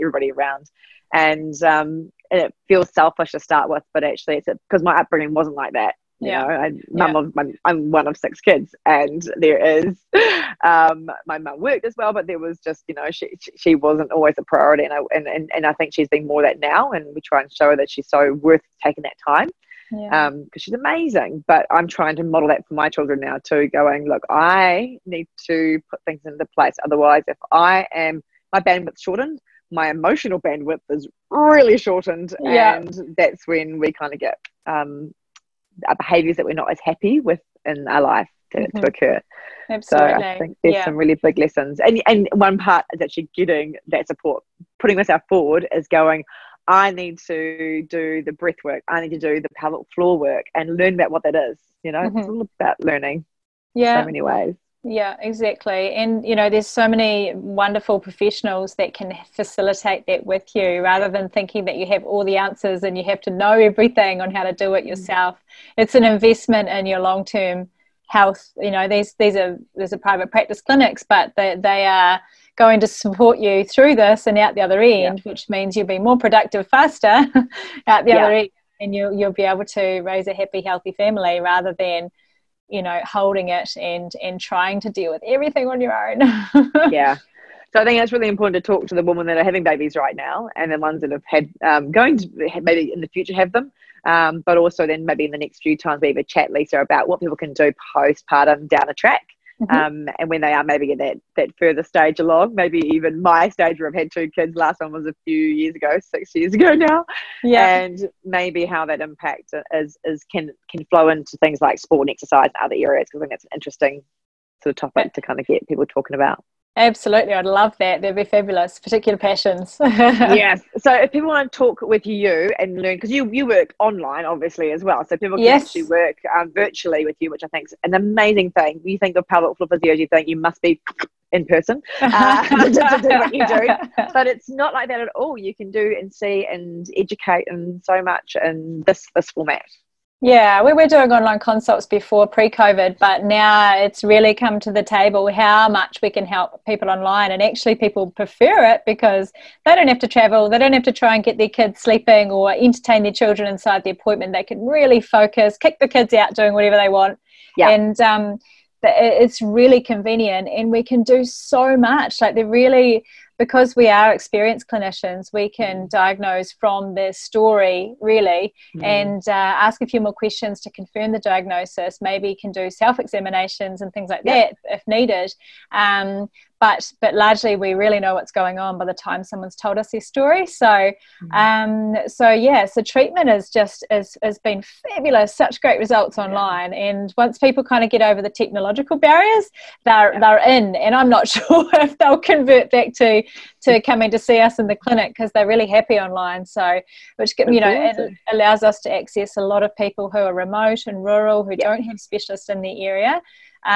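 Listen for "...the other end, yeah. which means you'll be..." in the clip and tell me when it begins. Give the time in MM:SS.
01:14.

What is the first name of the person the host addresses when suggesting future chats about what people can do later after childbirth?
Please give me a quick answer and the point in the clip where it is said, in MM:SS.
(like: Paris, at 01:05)
Lisa, at 01:36.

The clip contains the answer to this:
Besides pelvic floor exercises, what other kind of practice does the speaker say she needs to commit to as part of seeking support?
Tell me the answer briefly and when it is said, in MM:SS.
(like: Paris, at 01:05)
Breath work, at 00:48.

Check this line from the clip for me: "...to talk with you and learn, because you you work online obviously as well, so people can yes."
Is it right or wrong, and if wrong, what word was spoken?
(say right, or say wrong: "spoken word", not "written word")
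right.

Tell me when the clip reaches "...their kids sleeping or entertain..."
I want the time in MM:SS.
02:31.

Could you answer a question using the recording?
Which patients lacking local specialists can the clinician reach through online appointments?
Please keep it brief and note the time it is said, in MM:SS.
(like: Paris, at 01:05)
Remote and rural, at 03:20.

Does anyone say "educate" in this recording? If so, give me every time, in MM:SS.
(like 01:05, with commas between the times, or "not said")
02:16.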